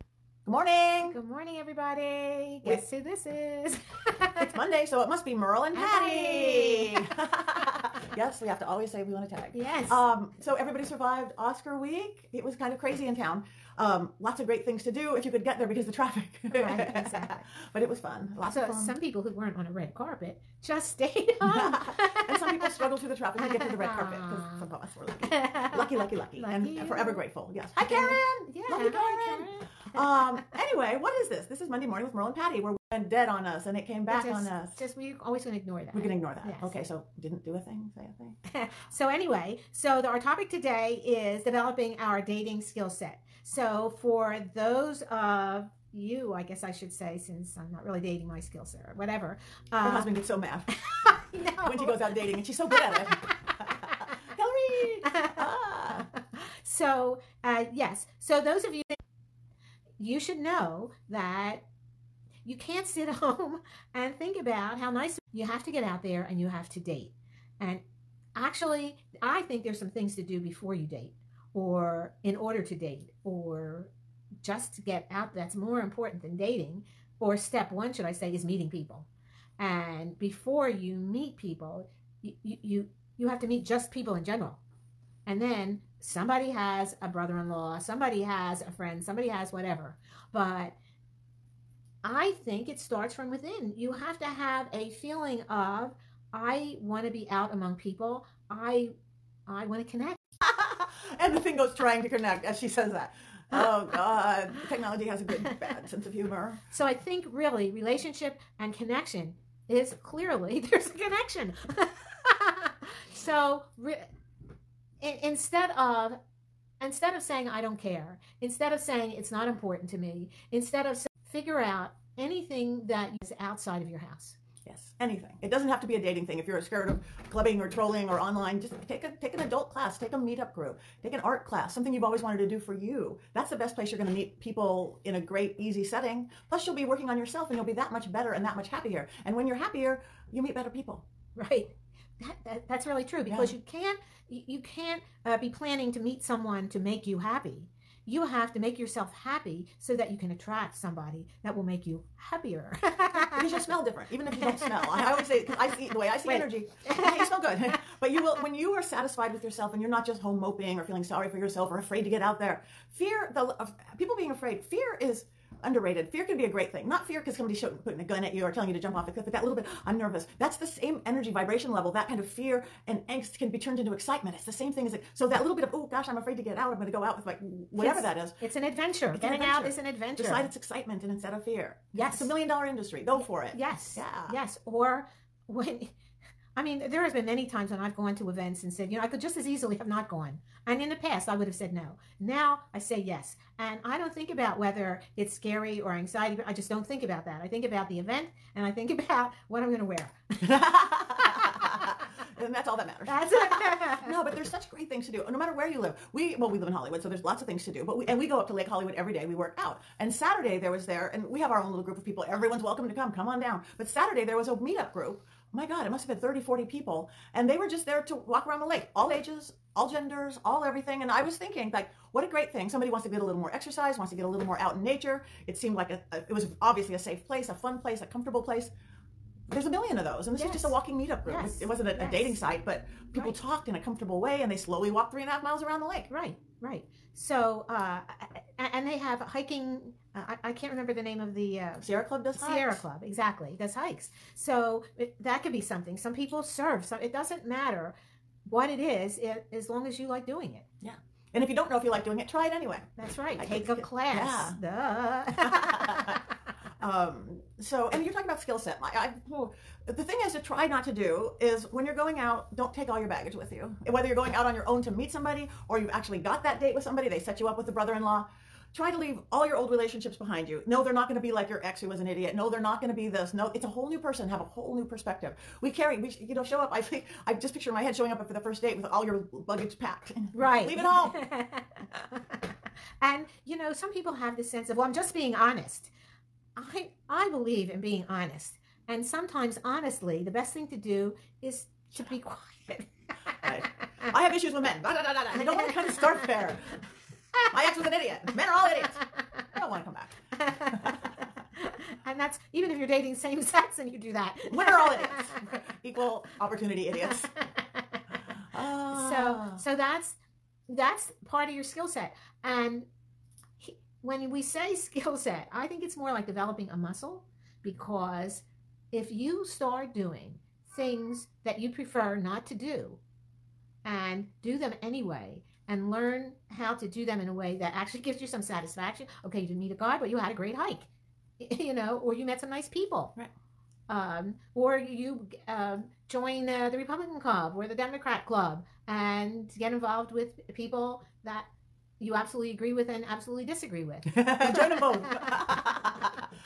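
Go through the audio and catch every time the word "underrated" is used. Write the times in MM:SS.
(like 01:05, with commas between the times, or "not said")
02:45.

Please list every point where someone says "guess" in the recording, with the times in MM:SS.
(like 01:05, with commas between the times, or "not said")
00:02, 00:46.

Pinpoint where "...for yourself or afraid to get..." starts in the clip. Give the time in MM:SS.
02:41.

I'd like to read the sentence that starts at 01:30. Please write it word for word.
But I think it starts from within.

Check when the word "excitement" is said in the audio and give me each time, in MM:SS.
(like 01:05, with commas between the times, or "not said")
02:53, 03:00.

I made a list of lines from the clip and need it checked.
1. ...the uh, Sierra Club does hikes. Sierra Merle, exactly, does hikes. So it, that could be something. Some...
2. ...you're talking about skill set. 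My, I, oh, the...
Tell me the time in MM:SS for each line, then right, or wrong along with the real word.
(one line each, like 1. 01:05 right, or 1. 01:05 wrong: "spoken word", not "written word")
1. 04:01 wrong: "Club", not "Merle"
2. 04:18 right.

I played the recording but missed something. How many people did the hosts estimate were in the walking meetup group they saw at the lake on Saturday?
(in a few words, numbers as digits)
30 to 40.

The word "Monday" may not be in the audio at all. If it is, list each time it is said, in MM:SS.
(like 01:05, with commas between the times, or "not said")
00:04, 00:31.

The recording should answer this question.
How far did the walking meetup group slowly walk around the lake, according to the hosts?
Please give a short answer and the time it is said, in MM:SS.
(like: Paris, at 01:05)
3.5 miles, at 03:55.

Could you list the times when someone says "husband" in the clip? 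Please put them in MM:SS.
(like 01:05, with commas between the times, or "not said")
00:49.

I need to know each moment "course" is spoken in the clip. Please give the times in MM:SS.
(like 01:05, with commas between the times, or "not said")
not said.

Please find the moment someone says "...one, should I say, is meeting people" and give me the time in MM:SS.
01:17.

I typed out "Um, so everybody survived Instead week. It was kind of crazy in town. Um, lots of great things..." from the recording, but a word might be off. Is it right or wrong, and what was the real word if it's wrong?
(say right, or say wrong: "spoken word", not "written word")
wrong: "Oscar", not "Instead".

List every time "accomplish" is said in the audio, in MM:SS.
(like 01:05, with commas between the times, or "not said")
not said.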